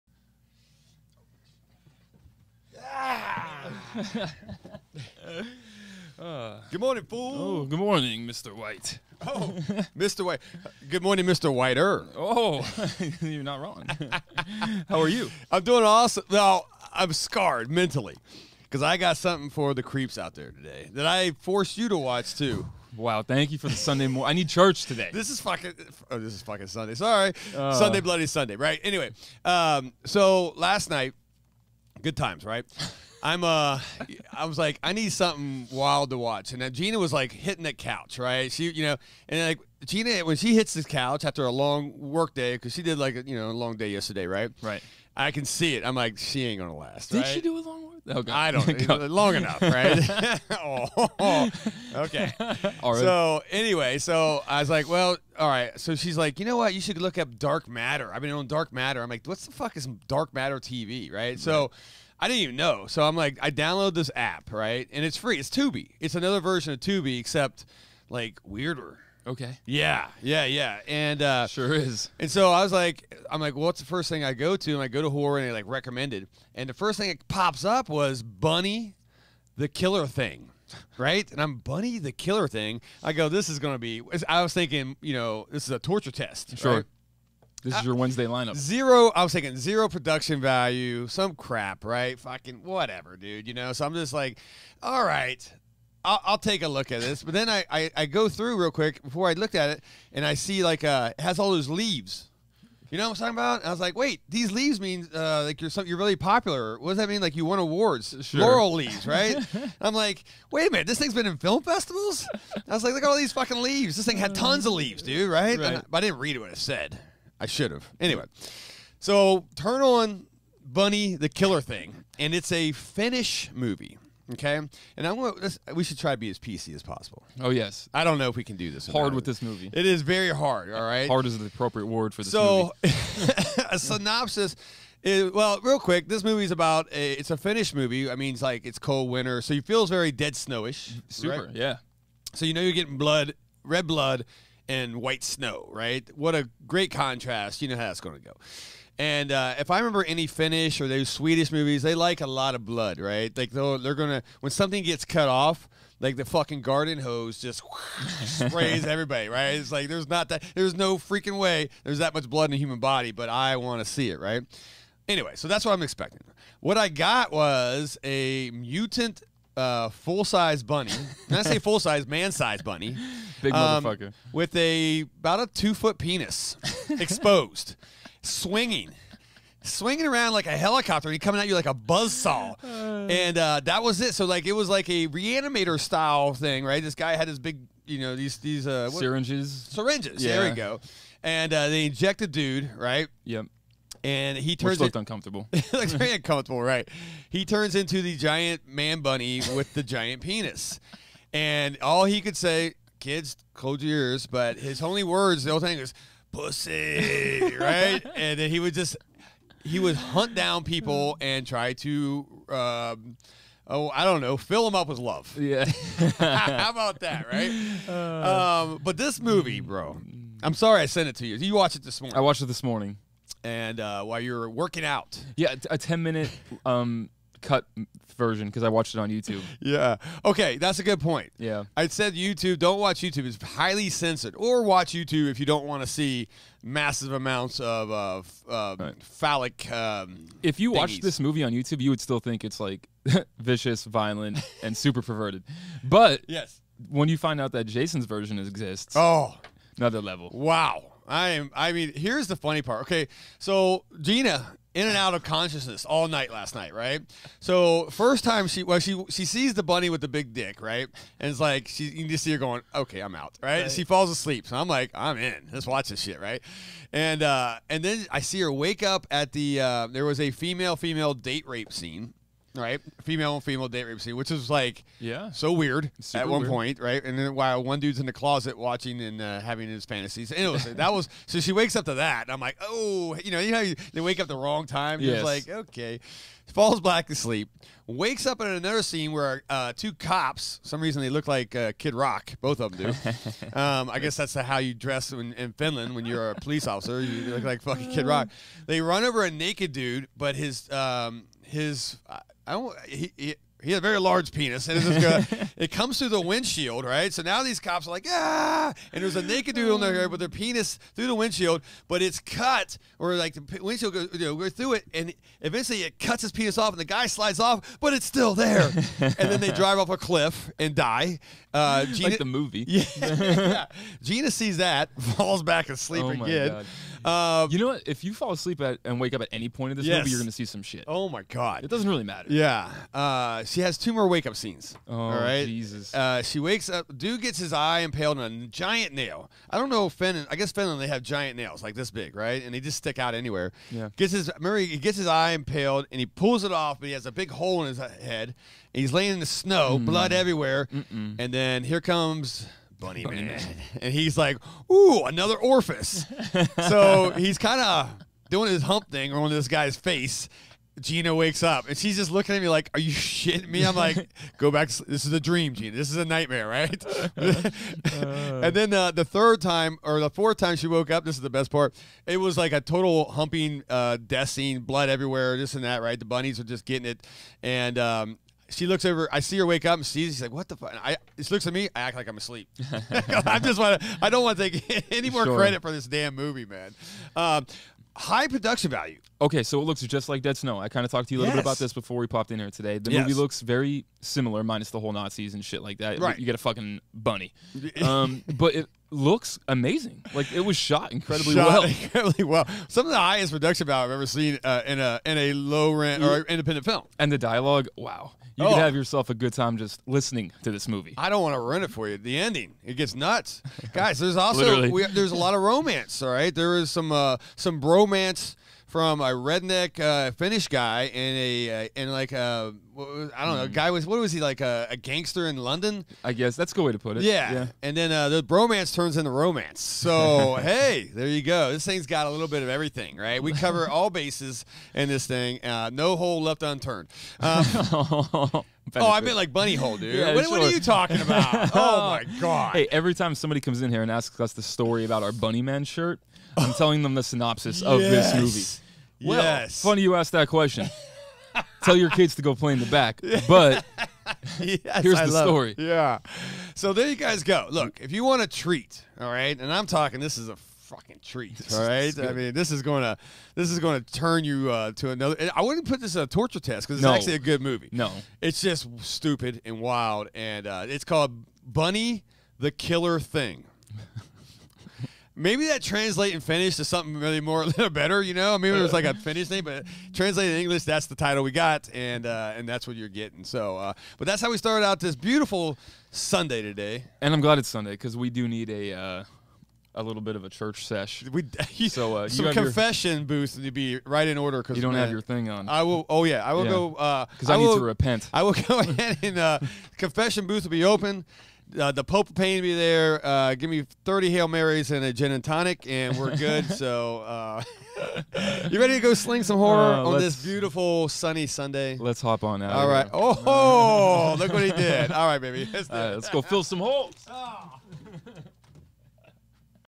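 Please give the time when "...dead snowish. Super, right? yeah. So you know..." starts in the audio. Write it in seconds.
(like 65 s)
140 s.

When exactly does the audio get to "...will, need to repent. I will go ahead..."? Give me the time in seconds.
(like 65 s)
497 s.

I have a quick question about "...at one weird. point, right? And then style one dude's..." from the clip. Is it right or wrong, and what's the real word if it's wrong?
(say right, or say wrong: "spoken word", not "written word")
wrong: "while", not "style".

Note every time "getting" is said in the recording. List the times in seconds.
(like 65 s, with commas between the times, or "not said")
142 s, 376 s, 482 s.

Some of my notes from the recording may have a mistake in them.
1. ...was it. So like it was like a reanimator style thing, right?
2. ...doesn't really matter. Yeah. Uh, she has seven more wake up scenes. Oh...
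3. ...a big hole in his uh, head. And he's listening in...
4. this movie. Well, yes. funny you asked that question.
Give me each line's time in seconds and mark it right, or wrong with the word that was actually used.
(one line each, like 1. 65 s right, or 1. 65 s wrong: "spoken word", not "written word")
1. 183 s right
2. 331 s wrong: "two", not "seven"
3. 347 s wrong: "laying", not "listening"
4. 448 s right.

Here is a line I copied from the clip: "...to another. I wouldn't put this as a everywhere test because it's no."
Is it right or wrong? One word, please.
wrong.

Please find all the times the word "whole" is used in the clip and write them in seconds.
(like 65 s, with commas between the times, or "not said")
205 s, 394 s.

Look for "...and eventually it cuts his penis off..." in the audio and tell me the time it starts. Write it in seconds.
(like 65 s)
314 s.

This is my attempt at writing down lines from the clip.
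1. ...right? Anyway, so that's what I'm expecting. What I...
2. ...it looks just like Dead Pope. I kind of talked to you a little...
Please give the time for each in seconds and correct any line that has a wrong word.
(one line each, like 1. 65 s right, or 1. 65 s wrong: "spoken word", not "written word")
1. 164 s right
2. 389 s wrong: "Snow", not "Pope".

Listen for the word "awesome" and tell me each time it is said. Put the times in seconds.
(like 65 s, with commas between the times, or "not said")
15 s.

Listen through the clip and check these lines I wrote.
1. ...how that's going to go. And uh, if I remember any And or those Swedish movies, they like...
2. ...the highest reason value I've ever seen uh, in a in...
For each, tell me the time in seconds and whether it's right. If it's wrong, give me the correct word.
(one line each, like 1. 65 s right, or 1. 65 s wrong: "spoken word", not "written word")
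1. 147 s wrong: "Finnish", not "And"
2. 402 s wrong: "production", not "reason".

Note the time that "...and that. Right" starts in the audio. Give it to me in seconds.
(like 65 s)
375 s.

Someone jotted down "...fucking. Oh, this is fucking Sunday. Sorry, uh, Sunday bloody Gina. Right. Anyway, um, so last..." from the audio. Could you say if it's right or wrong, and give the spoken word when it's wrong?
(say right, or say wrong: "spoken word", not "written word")
wrong: "Sunday", not "Gina".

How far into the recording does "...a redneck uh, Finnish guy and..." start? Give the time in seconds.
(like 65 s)
419 s.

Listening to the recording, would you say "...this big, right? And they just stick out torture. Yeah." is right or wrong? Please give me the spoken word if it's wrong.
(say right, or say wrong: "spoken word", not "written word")
wrong: "anywhere", not "torture".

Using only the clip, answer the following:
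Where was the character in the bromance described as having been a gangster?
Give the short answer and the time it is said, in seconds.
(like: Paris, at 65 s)
London, at 425 s.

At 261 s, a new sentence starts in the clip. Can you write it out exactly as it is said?
And it's like she you just see her going, okay, I'm out, right?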